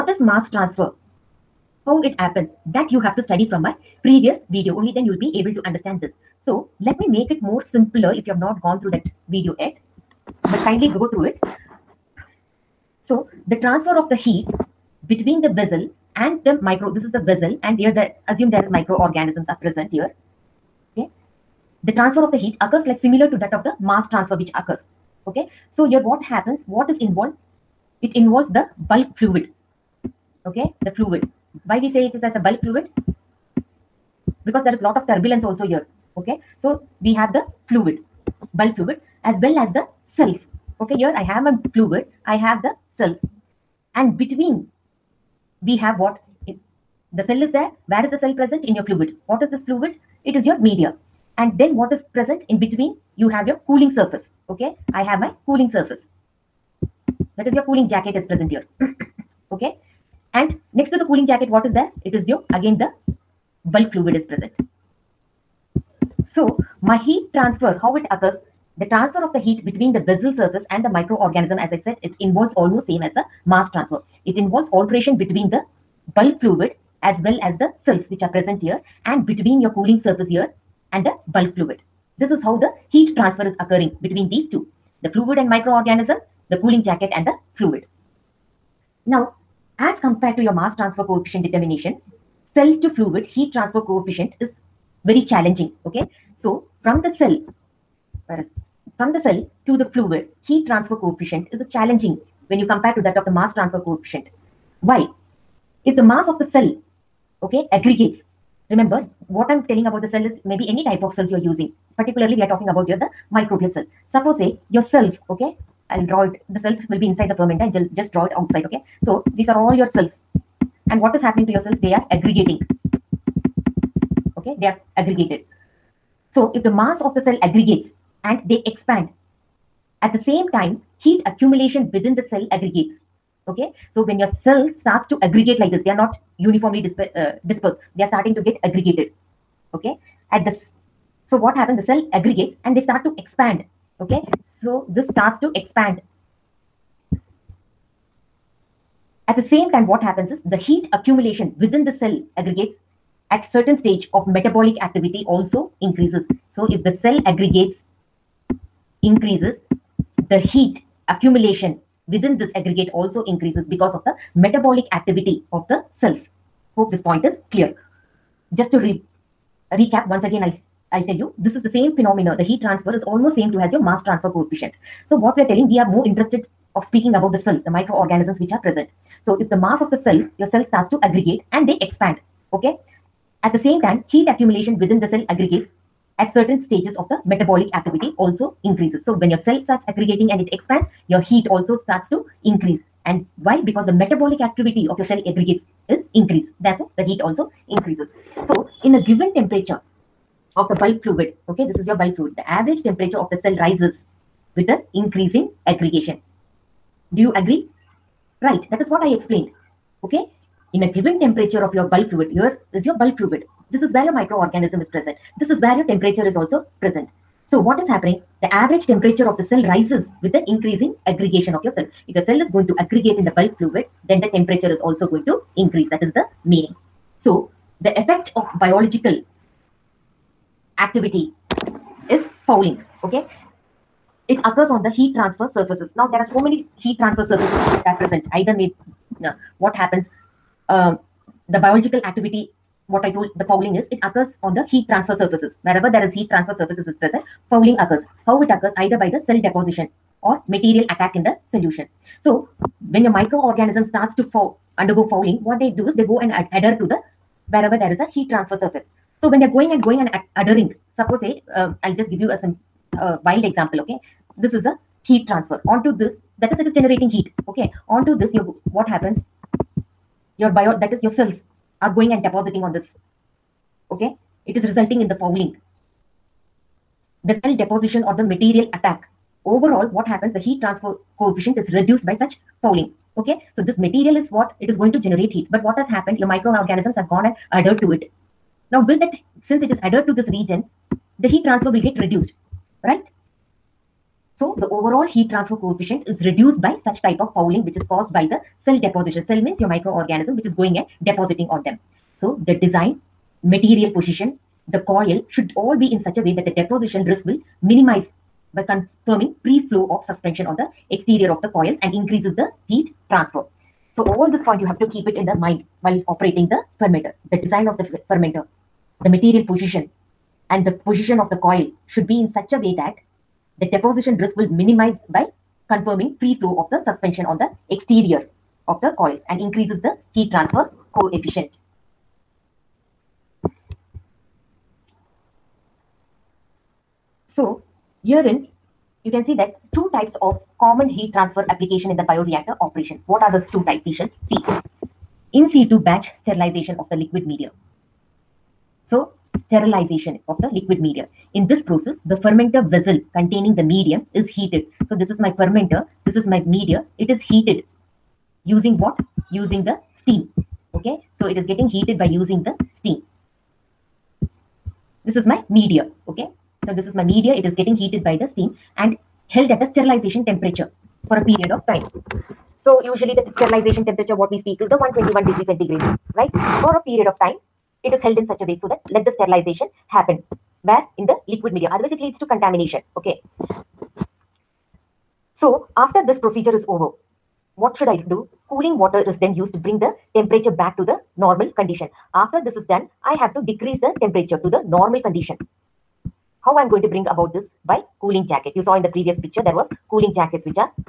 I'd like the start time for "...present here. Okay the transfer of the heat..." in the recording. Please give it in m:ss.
0:19.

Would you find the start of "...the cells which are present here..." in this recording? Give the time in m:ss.
1:17.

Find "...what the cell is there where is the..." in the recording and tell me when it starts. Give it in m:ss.
0:45.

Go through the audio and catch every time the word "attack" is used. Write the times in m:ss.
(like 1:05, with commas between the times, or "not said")
4:10, 4:38.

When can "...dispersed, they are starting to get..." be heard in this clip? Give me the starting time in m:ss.
2:17.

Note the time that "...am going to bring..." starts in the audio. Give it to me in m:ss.
6:36.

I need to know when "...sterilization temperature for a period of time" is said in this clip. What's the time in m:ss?
6:09.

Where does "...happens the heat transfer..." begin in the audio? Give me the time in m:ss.
4:40.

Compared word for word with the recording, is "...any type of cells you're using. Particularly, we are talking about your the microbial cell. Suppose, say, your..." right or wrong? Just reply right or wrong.
right.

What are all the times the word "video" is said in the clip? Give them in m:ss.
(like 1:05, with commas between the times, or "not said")
0:04, 0:09.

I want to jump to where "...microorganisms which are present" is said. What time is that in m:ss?
2:57.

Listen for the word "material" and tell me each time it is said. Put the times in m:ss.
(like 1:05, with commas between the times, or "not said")
4:10, 4:38, 4:43, 5:03, 5:19.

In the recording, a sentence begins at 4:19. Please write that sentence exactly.
So when they're going and going and ad- adhering, suppose say, uh, I'll just give you a some uh, wild example, okay?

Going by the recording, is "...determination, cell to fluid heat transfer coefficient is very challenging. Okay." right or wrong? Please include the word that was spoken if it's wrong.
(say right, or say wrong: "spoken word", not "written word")
right.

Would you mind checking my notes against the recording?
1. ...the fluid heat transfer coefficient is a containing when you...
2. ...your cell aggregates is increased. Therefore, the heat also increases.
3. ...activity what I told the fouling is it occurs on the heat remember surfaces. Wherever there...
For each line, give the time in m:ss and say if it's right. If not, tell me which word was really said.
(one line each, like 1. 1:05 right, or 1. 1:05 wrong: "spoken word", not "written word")
1. 1:39 wrong: "challenging", not "containing"
2. 3:14 right
3. 4:02 wrong: "transfer", not "remember".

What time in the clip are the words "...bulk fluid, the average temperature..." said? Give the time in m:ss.
3:21.